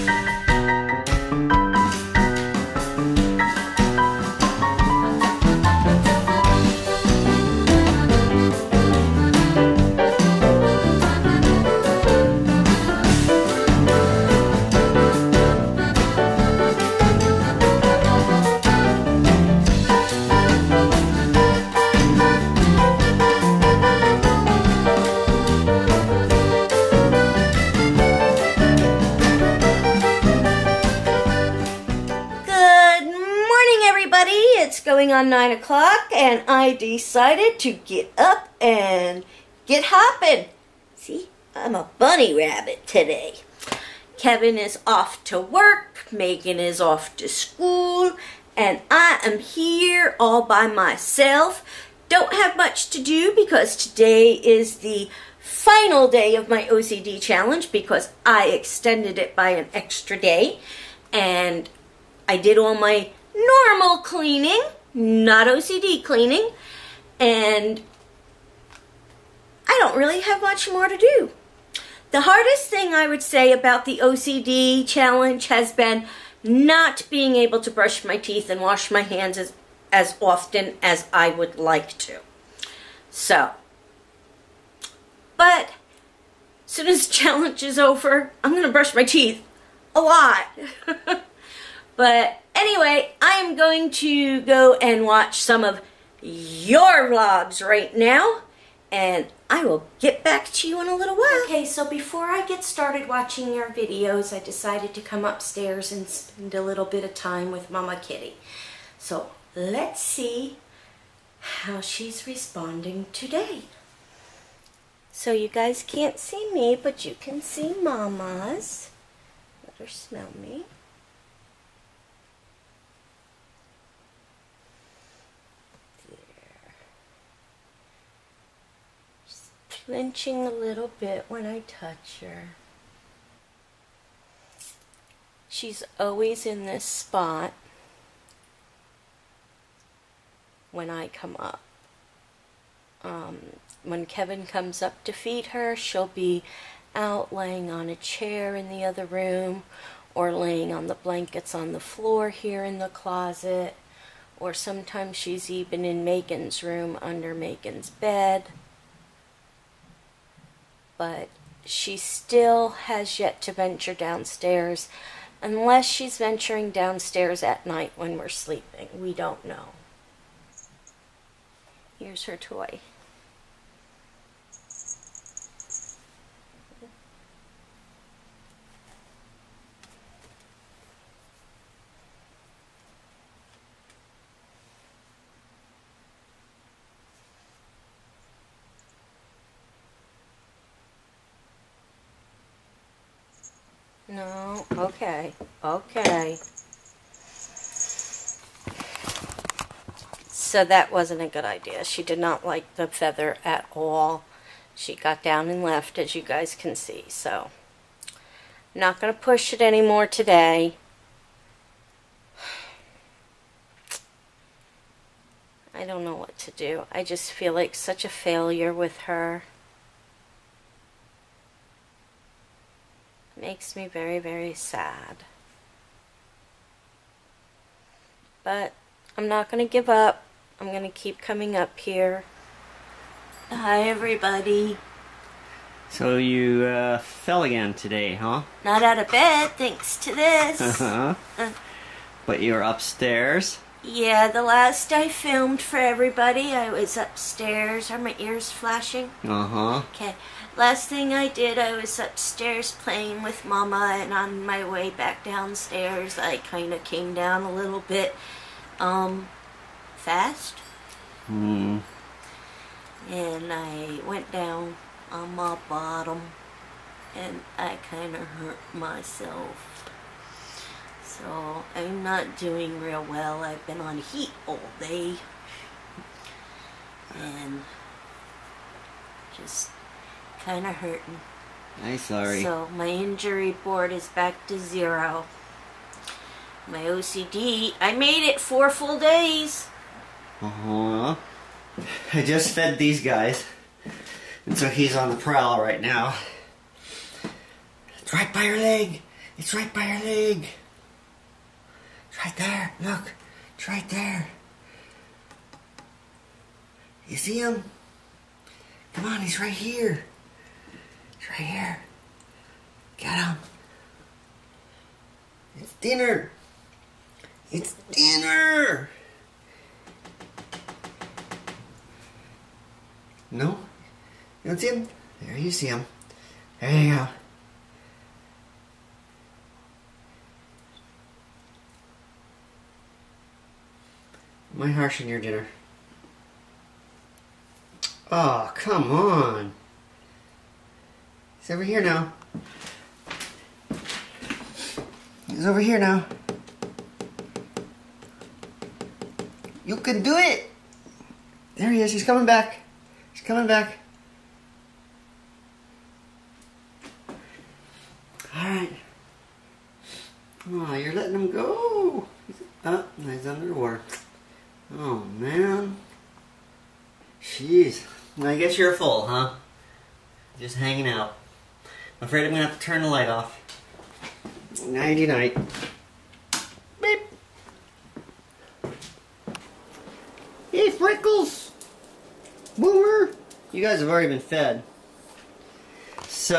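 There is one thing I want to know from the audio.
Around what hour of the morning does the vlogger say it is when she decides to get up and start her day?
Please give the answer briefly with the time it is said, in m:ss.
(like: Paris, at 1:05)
9 o'clock, at 0:35.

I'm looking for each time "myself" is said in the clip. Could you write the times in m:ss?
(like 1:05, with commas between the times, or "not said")
0:50, 4:28.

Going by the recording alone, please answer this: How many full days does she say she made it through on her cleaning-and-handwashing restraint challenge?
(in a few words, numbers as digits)
4.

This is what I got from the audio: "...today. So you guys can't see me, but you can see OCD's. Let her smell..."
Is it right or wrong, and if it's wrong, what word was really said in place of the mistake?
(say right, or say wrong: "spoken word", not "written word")
wrong: "Mama", not "OCD".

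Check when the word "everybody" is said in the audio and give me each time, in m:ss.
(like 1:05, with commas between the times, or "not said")
0:34, 3:53, 4:05.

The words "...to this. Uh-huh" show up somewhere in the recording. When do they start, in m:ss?
3:59.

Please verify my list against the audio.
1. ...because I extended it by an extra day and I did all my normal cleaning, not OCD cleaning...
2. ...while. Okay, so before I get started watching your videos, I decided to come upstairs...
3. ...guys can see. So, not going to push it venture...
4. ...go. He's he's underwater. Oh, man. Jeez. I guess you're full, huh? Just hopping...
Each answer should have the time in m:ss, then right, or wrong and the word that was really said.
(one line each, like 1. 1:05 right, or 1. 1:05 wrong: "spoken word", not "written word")
1. 0:57 right
2. 1:41 right
3. 3:26 wrong: "anymore", not "venture"
4. 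6:01 wrong: "hanging", not "hopping".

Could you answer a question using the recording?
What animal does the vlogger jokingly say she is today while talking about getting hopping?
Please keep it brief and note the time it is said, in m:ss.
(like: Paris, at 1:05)
bunny rabbit, at 0:41.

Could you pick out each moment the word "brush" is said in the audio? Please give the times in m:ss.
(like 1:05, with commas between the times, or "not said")
1:17, 1:28.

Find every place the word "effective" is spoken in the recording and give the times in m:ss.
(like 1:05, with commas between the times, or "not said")
not said.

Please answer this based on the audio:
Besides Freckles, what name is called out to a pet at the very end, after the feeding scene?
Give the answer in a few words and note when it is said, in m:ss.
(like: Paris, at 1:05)
Boomer, at 6:22.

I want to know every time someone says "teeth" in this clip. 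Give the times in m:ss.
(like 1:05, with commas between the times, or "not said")
1:18, 1:29.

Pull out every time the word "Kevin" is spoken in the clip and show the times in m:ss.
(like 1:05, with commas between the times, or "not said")
0:44, 2:24.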